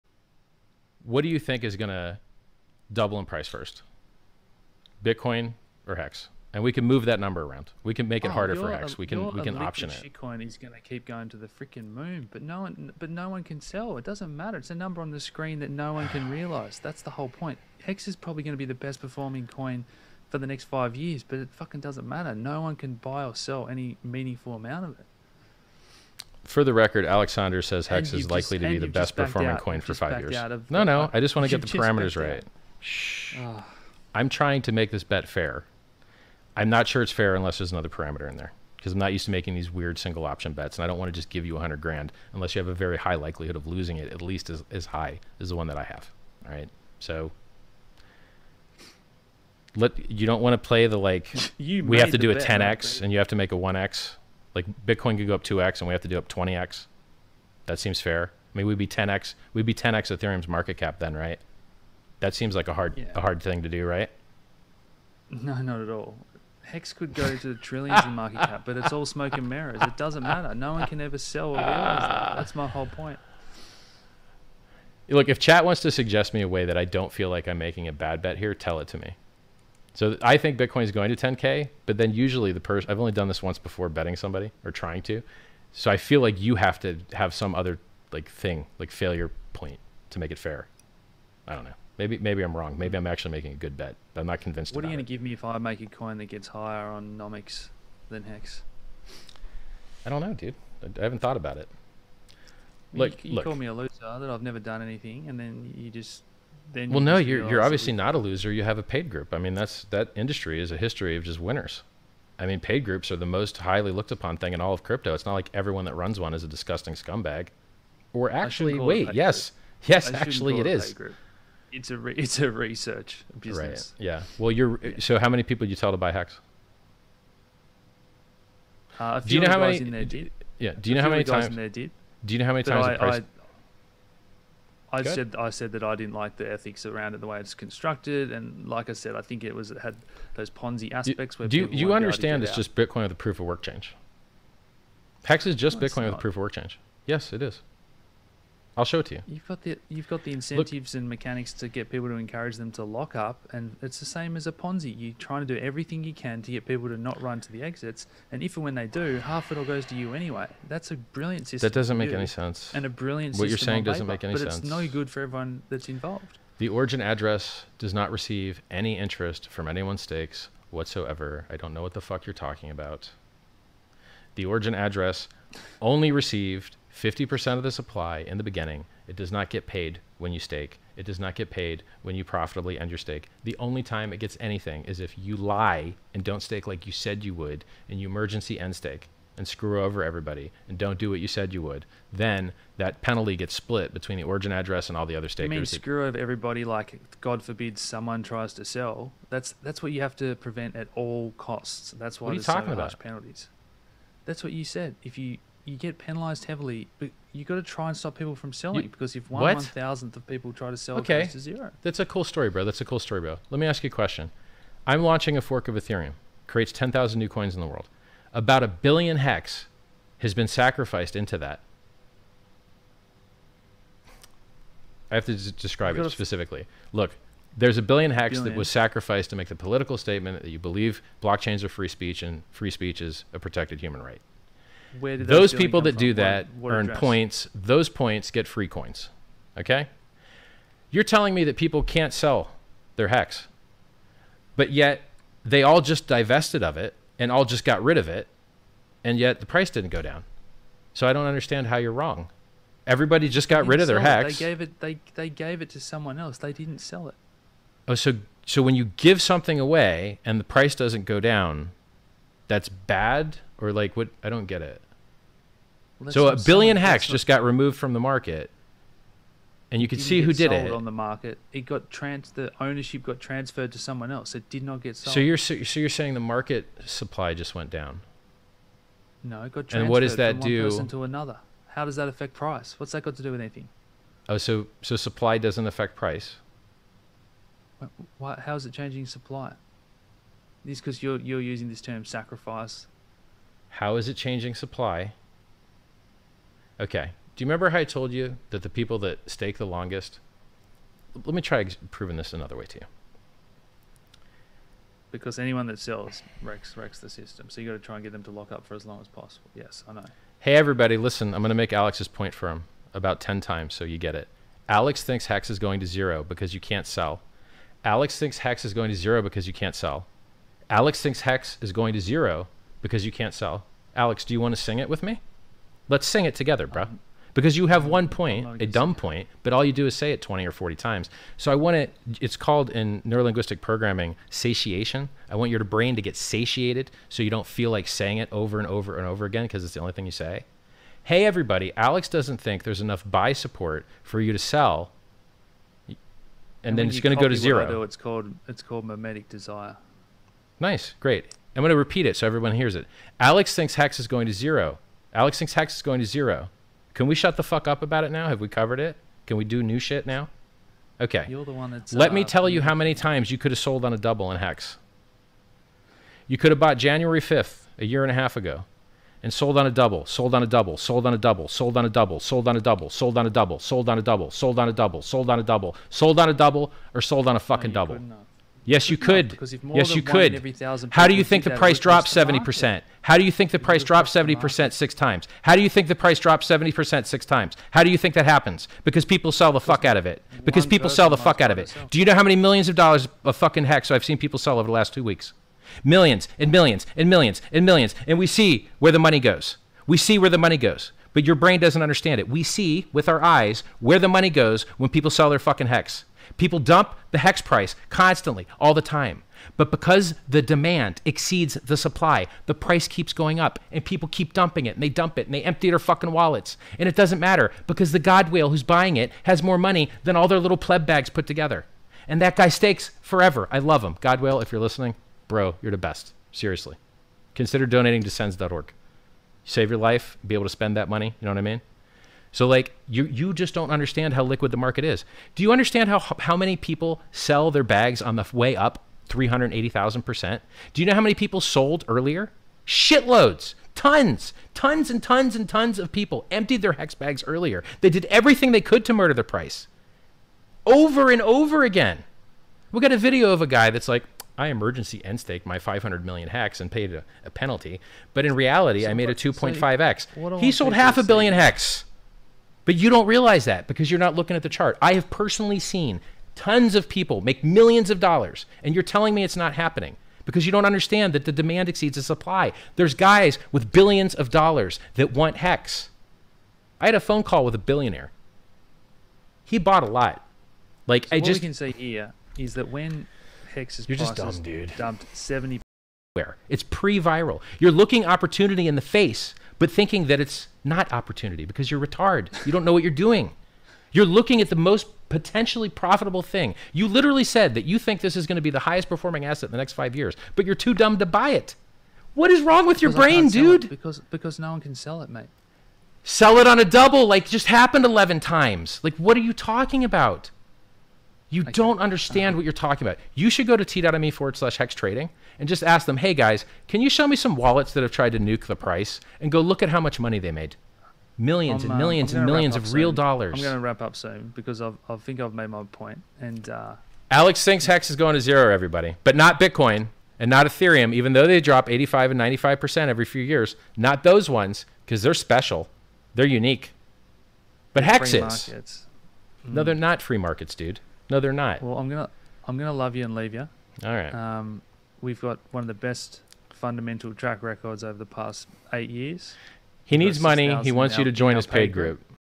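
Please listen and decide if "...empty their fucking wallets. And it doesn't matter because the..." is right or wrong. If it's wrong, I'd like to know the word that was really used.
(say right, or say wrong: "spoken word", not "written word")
right.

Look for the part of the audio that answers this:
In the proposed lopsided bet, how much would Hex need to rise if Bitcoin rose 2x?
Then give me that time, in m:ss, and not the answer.
0:56.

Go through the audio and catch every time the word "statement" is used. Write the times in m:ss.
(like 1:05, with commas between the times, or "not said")
3:49.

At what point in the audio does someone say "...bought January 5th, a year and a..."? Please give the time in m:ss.
6:06.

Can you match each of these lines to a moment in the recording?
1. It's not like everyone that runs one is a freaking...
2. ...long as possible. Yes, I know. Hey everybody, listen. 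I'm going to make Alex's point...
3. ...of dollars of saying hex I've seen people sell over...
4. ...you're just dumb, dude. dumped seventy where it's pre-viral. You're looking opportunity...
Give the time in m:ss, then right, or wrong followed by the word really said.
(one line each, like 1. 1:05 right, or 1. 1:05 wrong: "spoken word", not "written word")
1. 1:55 wrong: "disgusting", not "freaking"
2. 5:08 right
3. 6:32 wrong: "fucking", not "saying"
4. 8:03 right.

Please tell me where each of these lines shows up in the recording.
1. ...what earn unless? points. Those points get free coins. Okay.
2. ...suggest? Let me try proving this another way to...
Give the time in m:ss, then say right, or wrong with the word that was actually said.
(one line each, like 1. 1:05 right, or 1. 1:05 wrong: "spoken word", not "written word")
1. 3:56 wrong: "address", not "unless"
2. 4:59 wrong: "longest", not "suggest".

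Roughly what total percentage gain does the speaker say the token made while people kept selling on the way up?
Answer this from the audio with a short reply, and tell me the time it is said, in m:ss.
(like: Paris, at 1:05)
380,000%, at 7:19.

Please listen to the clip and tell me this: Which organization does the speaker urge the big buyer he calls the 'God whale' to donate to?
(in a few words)
sens.org.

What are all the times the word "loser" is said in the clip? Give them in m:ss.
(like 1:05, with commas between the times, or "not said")
1:43, 1:48.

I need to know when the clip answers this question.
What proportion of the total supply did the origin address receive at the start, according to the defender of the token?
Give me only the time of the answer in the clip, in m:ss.
2:56.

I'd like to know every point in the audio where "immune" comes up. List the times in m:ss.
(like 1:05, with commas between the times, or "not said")
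not said.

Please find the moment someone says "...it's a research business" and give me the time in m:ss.
2:02.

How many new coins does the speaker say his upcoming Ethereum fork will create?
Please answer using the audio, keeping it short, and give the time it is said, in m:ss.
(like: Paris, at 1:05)
10,000, at 3:36.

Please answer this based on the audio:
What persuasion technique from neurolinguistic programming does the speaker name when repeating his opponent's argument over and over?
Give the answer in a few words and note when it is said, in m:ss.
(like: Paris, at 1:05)
satiation, at 5:34.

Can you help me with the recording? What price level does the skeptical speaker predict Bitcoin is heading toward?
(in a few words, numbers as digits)
10K.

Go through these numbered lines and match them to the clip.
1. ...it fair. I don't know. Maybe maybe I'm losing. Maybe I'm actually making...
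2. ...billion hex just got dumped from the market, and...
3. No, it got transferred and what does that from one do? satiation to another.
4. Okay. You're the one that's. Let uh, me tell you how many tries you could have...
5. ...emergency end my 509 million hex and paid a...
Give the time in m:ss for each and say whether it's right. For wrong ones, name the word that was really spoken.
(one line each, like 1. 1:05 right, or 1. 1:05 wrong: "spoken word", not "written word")
1. 1:30 wrong: "wrong", not "losing"
2. 4:26 wrong: "removed", not "dumped"
3. 4:39 wrong: "person", not "satiation"
4. 6:00 wrong: "times", not "tries"
5. 7:34 wrong: "500", not "509".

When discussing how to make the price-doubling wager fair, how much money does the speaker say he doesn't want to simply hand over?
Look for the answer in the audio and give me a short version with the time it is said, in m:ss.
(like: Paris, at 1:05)
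100 grand, at 0:41.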